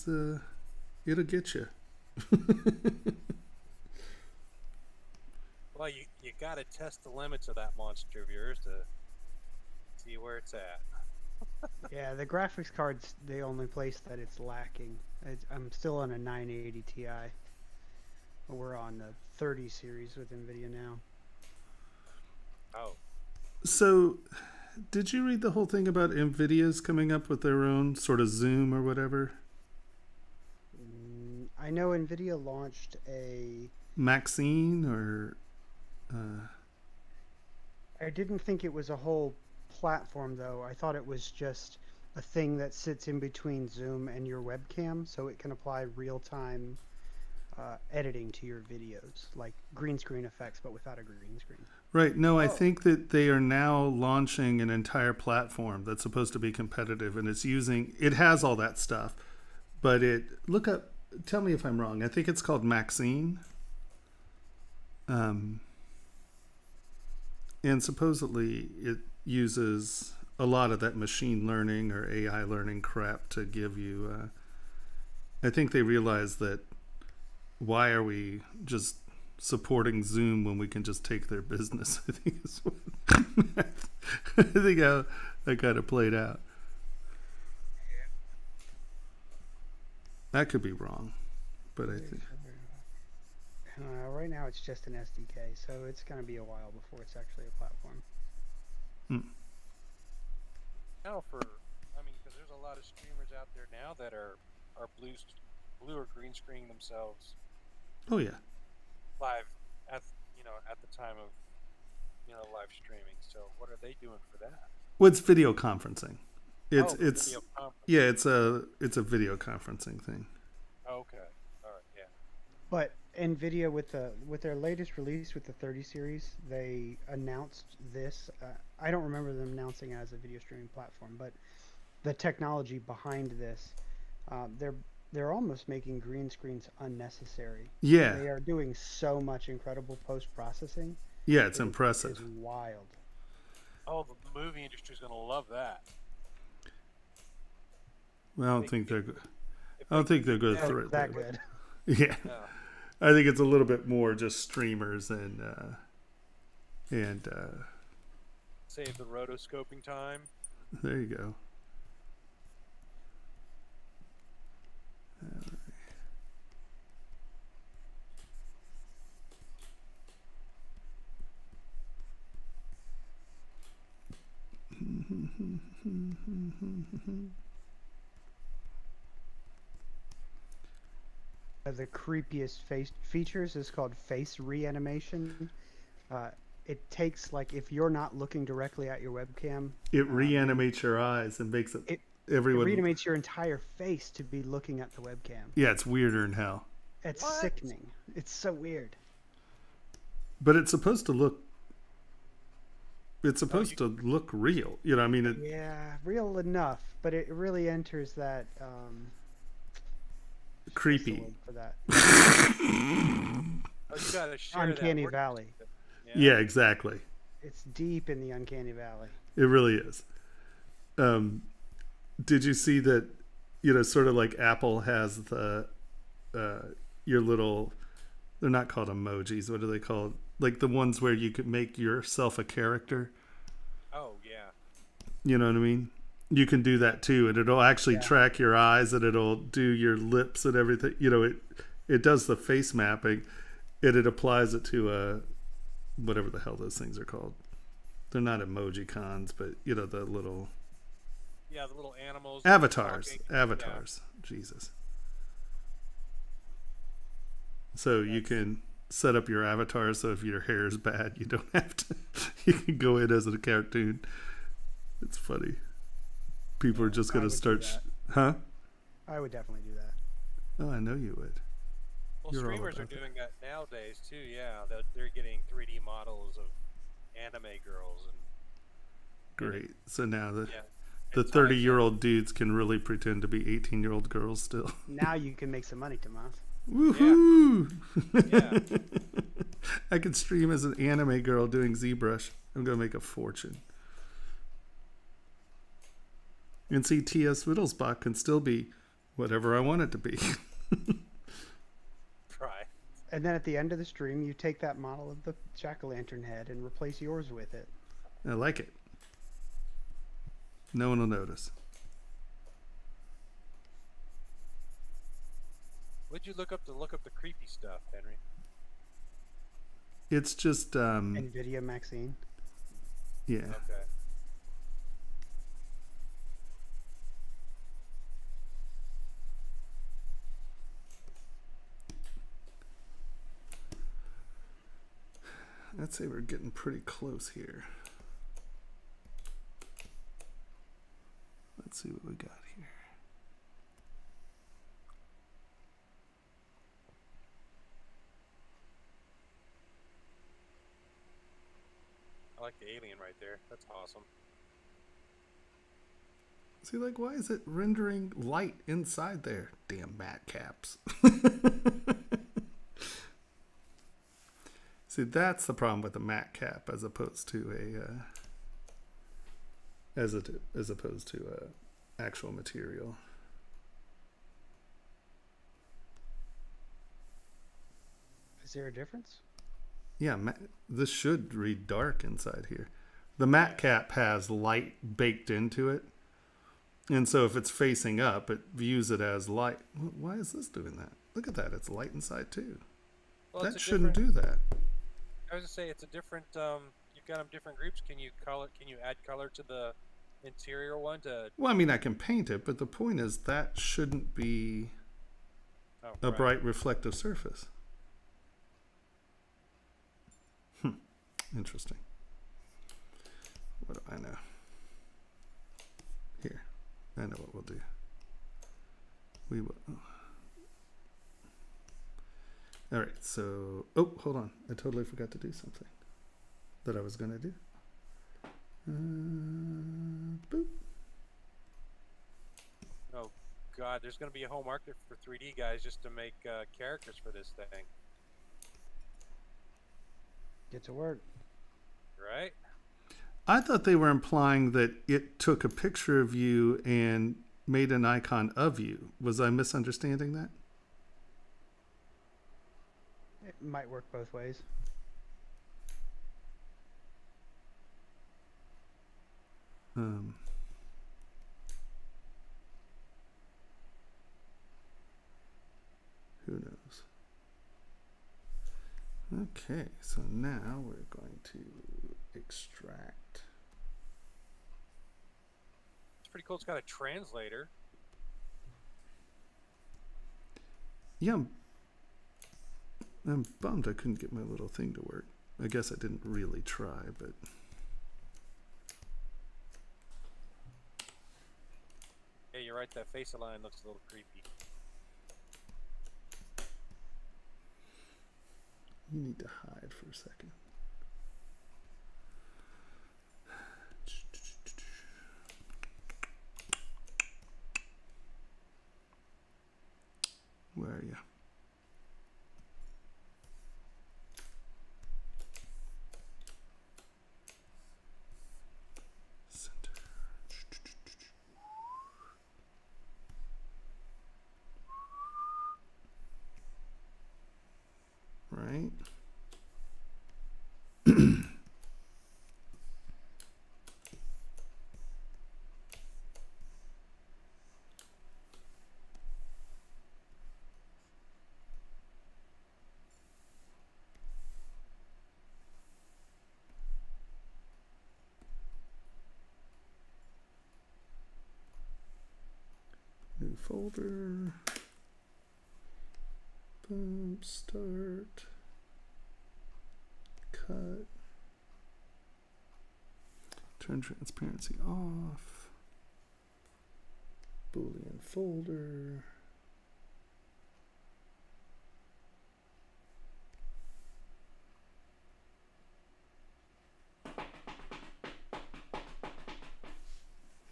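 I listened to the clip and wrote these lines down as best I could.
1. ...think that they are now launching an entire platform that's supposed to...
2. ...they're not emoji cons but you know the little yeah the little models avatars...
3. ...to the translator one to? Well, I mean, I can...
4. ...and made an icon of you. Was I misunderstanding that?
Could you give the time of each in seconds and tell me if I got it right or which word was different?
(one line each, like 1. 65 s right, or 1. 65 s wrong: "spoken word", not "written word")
1. 52 s right
2. 248 s wrong: "animals", not "models"
3. 399 s wrong: "interior", not "translator"
4. 446 s right.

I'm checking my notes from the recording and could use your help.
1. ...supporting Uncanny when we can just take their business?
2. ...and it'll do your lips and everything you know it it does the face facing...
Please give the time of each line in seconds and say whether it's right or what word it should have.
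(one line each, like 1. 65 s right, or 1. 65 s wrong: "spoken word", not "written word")
1. 79 s wrong: "Zoom", not "Uncanny"
2. 238 s wrong: "mapping", not "facing".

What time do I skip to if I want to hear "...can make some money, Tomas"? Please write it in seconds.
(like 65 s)
285 s.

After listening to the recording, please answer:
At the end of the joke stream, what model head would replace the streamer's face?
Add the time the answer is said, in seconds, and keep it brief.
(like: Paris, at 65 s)
jack o' lantern, at 305 s.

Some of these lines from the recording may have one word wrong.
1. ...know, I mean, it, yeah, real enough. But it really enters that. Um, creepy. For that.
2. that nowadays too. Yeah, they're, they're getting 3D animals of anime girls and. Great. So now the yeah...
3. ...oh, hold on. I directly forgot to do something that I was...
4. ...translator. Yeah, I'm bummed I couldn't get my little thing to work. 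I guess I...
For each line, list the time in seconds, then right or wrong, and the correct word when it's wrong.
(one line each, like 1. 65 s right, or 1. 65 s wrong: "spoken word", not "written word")
1. 204 s right
2. 273 s wrong: "models", not "animals"
3. 423 s wrong: "totally", not "directly"
4. 476 s right.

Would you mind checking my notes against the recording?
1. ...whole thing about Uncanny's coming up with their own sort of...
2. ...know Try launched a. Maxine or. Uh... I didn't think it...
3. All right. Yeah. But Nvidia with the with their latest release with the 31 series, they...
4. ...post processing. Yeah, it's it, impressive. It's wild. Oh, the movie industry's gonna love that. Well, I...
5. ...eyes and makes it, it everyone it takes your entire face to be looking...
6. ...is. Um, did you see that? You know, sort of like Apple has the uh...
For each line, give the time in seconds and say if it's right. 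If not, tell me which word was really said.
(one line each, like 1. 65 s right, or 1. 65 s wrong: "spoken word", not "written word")
1. 25 s wrong: "NVIDIA", not "Uncanny"
2. 31 s wrong: "NVIDIA", not "Try"
3. 121 s wrong: "30", not "31"
4. 140 s right
5. 190 s wrong: "reanimates", not "takes"
6. 219 s right.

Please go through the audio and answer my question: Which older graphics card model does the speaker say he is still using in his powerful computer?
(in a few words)
980 Ti.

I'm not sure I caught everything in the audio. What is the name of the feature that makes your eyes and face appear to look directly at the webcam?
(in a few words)
face reanimation.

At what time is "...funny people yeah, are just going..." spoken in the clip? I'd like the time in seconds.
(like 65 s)
265 s.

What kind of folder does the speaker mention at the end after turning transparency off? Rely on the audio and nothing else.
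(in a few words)
Boolean folder.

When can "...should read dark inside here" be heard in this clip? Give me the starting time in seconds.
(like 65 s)
380 s.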